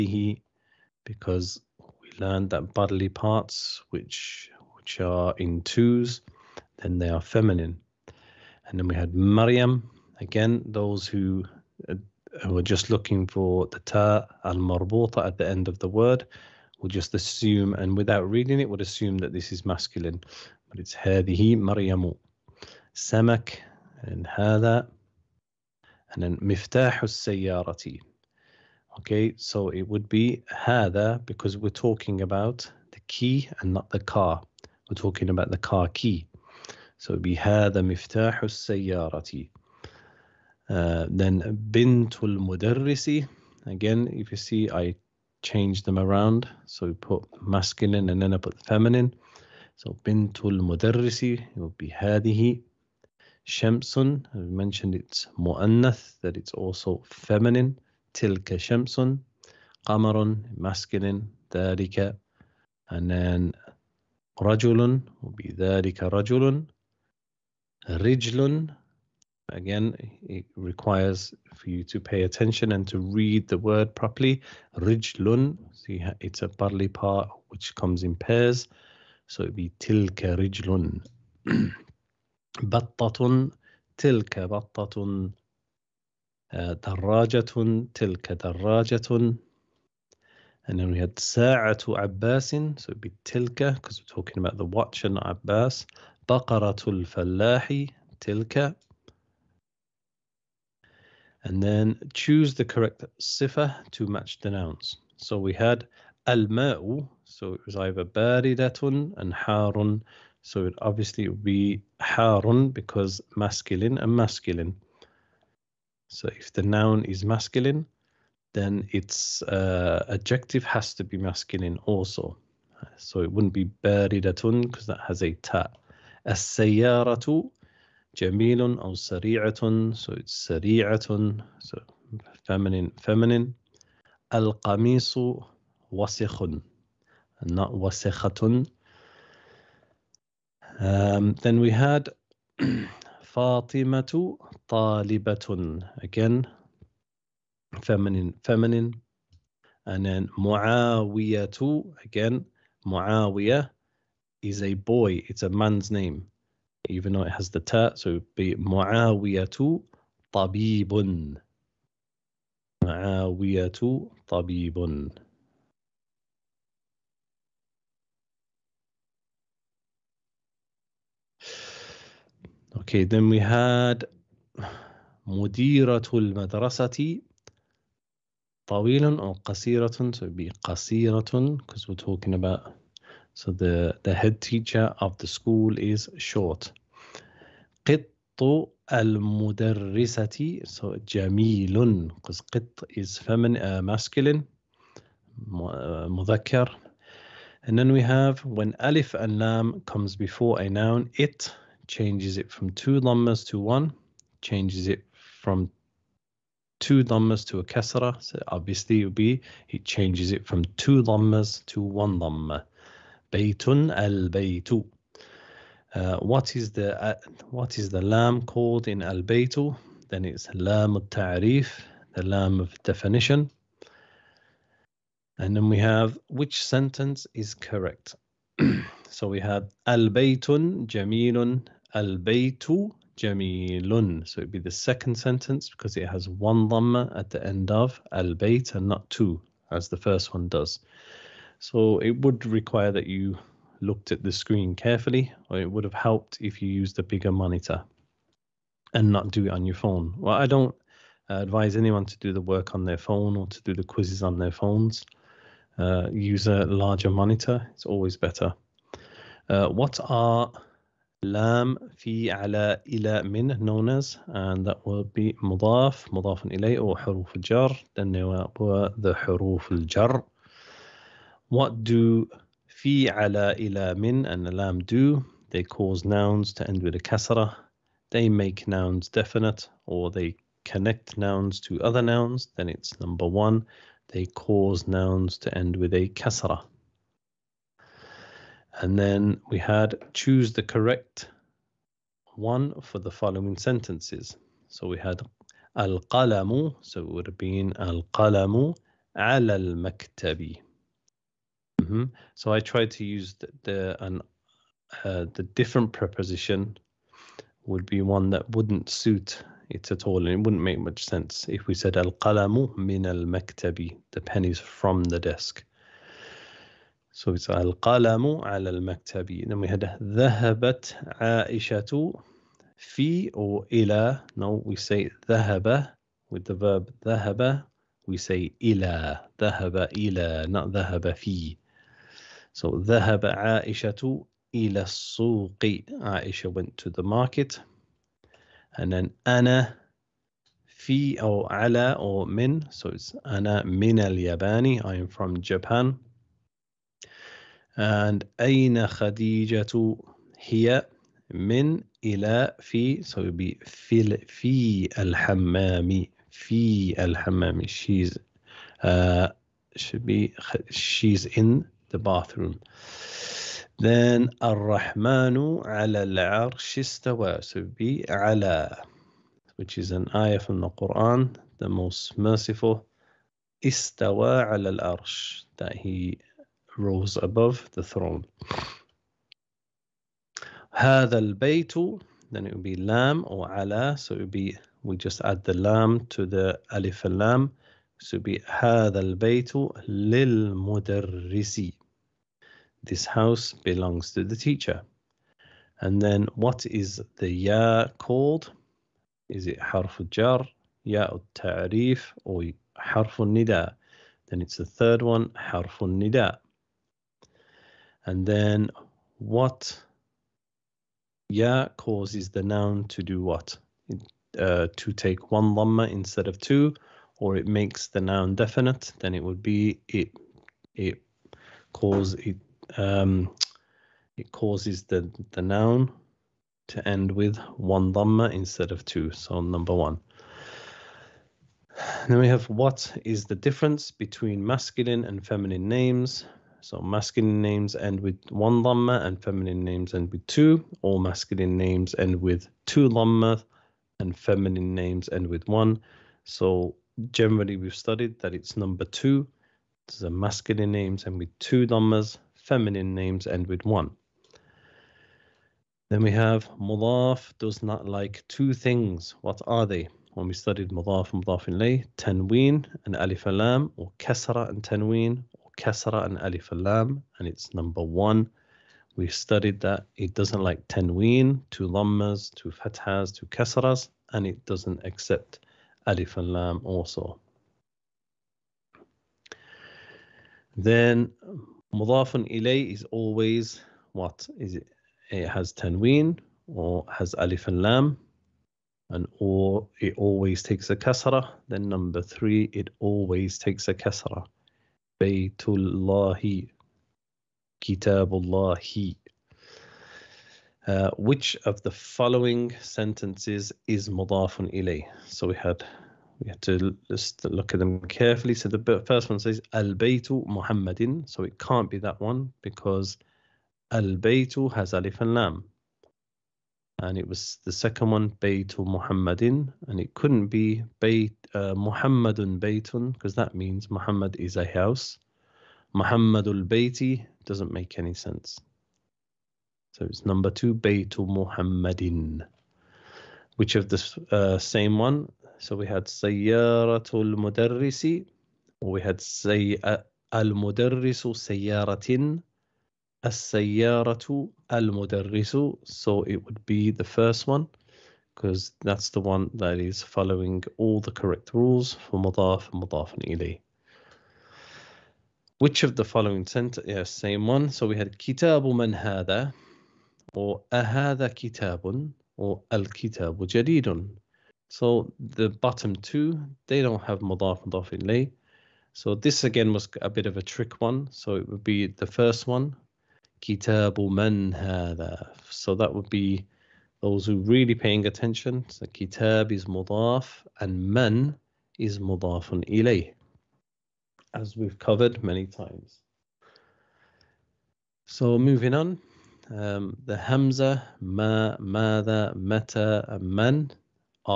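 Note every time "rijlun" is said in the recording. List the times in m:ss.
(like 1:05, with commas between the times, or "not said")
1:07, 1:14, 1:20.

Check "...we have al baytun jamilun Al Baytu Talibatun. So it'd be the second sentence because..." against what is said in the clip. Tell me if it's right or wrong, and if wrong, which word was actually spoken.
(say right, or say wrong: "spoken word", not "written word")
wrong: "Jamilun", not "Talibatun".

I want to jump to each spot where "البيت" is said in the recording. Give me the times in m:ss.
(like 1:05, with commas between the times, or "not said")
6:21, 6:28.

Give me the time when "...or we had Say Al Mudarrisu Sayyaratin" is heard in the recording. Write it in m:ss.
8:58.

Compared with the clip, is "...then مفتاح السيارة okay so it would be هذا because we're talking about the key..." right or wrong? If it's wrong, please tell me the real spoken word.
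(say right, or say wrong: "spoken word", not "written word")
right.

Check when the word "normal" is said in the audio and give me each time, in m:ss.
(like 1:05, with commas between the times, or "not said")
not said.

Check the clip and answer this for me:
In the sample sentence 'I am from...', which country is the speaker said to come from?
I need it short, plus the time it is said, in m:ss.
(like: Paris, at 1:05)
Japan, at 5:45.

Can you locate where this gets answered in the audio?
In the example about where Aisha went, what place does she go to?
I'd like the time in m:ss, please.
5:34.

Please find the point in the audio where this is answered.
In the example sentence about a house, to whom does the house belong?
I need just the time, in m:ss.
6:34.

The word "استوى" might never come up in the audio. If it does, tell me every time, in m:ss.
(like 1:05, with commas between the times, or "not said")
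6:06, 6:13.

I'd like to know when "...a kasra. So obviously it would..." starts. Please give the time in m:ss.
3:27.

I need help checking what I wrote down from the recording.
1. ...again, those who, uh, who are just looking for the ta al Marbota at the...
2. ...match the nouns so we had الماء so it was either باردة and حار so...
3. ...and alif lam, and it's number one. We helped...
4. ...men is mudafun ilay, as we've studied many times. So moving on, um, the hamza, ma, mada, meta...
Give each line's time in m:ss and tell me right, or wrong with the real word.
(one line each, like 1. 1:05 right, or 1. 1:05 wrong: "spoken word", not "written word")
1. 0:10 right
2. 1:44 right
3. 7:46 wrong: "studied", not "helped"
4. 9:40 wrong: "covered", not "studied".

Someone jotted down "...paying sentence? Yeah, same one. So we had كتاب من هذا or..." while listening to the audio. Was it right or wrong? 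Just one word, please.
wrong.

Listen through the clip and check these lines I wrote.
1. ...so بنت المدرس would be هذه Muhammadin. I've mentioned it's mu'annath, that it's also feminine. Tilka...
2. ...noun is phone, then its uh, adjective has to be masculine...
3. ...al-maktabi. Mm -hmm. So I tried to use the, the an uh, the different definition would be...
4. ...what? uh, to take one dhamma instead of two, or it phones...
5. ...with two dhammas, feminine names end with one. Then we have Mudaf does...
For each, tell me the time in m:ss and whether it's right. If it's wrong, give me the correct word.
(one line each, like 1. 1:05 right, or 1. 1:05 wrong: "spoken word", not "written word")
1. 0:49 wrong: "Shamsun", not "Muhammadin"
2. 1:56 wrong: "masculine", not "phone"
3. 4:59 wrong: "preposition", not "definition"
4. 6:53 wrong: "makes", not "phones"
5. 7:31 right.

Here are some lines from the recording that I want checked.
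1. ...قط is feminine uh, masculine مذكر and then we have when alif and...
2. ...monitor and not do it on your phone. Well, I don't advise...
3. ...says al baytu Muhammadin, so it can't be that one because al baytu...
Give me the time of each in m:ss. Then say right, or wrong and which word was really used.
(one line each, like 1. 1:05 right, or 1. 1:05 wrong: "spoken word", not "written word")
1. 3:12 right
2. 4:07 right
3. 8:29 right.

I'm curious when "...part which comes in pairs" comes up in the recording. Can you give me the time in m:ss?
1:16.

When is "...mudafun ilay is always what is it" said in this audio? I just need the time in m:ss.
8:01.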